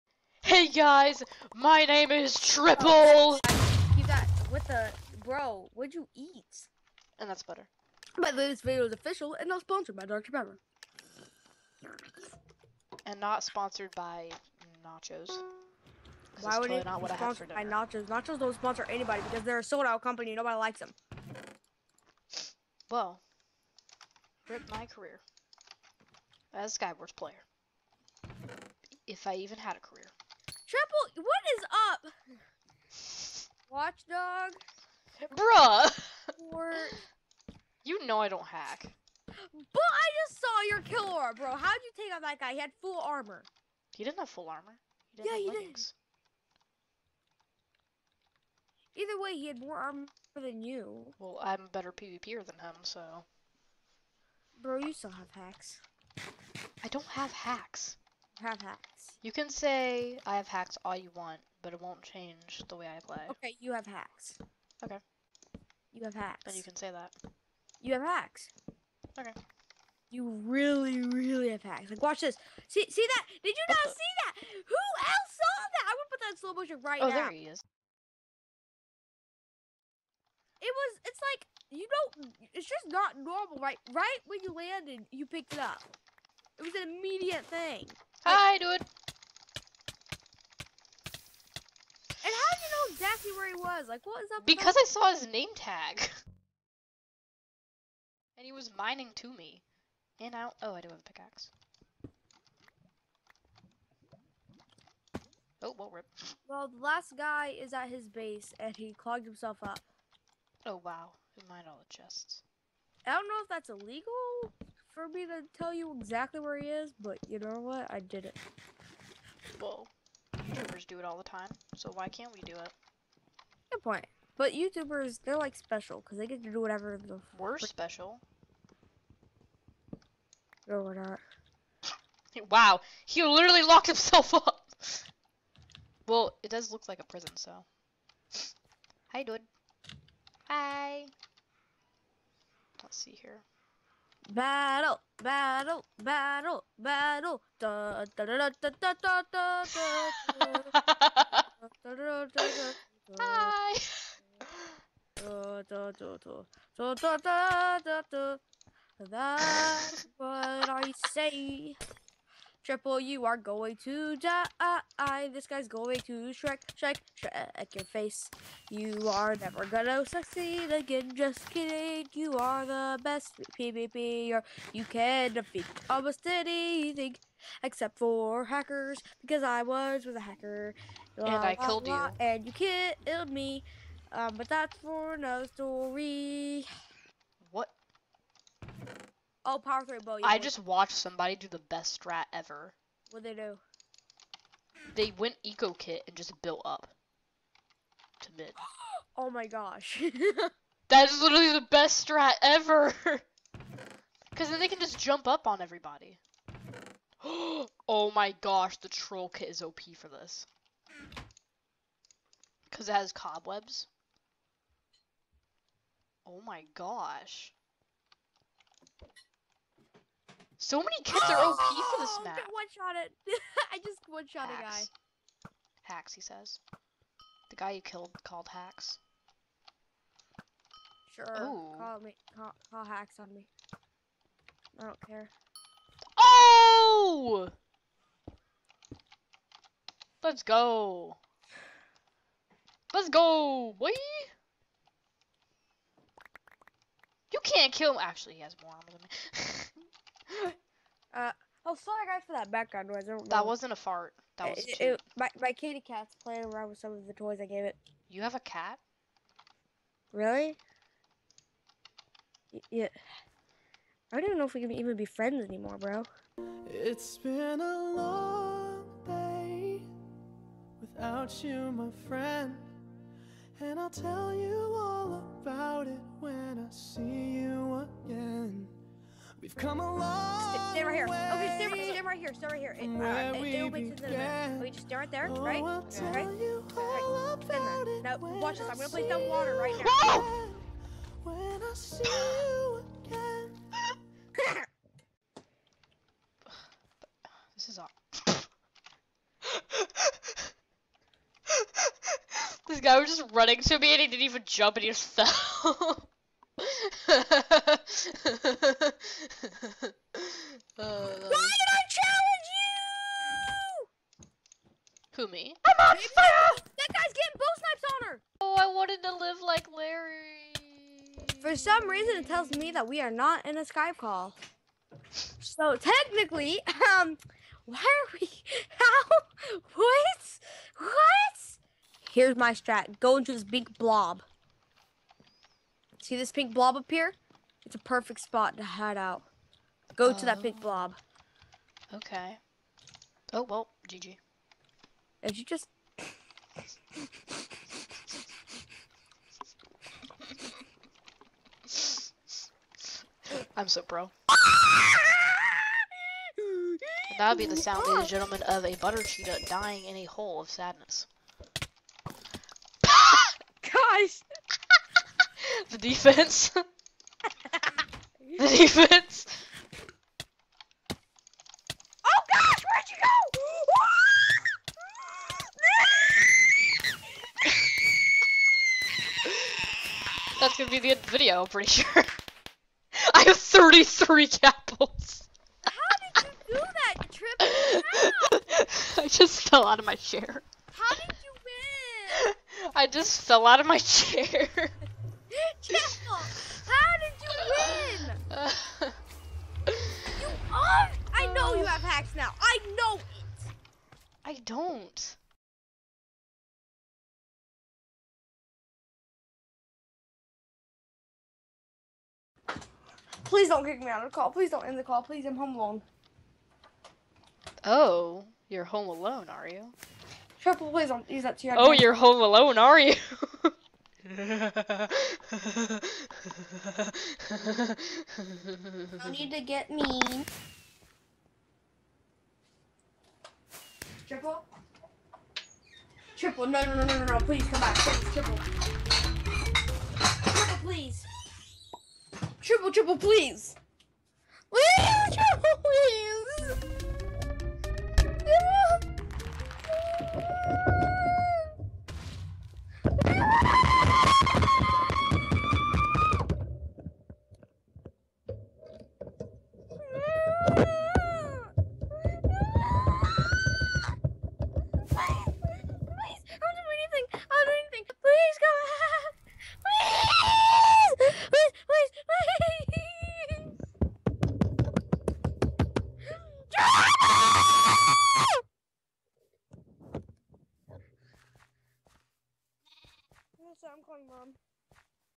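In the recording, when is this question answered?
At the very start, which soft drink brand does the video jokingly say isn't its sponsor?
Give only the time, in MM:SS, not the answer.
00:10.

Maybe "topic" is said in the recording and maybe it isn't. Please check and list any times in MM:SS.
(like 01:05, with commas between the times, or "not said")
not said.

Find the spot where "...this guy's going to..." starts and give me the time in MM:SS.
02:45.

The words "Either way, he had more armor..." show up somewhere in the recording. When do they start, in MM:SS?
00:49.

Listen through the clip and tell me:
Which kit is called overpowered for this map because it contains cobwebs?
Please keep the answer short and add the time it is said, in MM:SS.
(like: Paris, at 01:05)
troll kit, at 03:28.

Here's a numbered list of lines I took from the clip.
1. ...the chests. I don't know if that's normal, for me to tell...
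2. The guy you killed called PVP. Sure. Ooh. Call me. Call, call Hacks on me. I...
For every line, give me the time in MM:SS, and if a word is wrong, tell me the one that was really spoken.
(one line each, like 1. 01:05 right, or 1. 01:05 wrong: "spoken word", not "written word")
1. 01:51 wrong: "illegal", not "normal"
2. 03:47 wrong: "Hacks", not "PVP".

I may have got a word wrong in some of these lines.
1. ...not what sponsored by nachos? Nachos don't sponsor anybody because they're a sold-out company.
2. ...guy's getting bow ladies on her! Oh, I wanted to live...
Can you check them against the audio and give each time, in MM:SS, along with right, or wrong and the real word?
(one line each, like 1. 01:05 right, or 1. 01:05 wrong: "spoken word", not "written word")
1. 00:16 right
2. 05:16 wrong: "snipes", not "ladies".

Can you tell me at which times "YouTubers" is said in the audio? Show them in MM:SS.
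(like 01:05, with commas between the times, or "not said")
02:00, 02:04.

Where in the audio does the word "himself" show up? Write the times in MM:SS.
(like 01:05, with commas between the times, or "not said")
01:49, 02:13.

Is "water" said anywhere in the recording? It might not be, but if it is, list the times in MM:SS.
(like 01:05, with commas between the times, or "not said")
04:49.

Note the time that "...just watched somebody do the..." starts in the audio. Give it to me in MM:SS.
03:10.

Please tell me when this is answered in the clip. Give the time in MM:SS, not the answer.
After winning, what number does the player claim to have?
06:23.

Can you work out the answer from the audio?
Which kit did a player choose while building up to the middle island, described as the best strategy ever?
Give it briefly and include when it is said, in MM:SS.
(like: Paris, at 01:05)
eco kit, at 03:15.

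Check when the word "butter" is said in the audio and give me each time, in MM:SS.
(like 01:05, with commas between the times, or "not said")
00:07, 05:58.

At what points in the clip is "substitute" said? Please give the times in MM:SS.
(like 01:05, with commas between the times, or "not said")
not said.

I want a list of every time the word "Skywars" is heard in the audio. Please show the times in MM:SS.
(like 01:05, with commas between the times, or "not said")
00:26.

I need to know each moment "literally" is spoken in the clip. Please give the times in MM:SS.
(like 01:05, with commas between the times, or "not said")
02:13, 03:21.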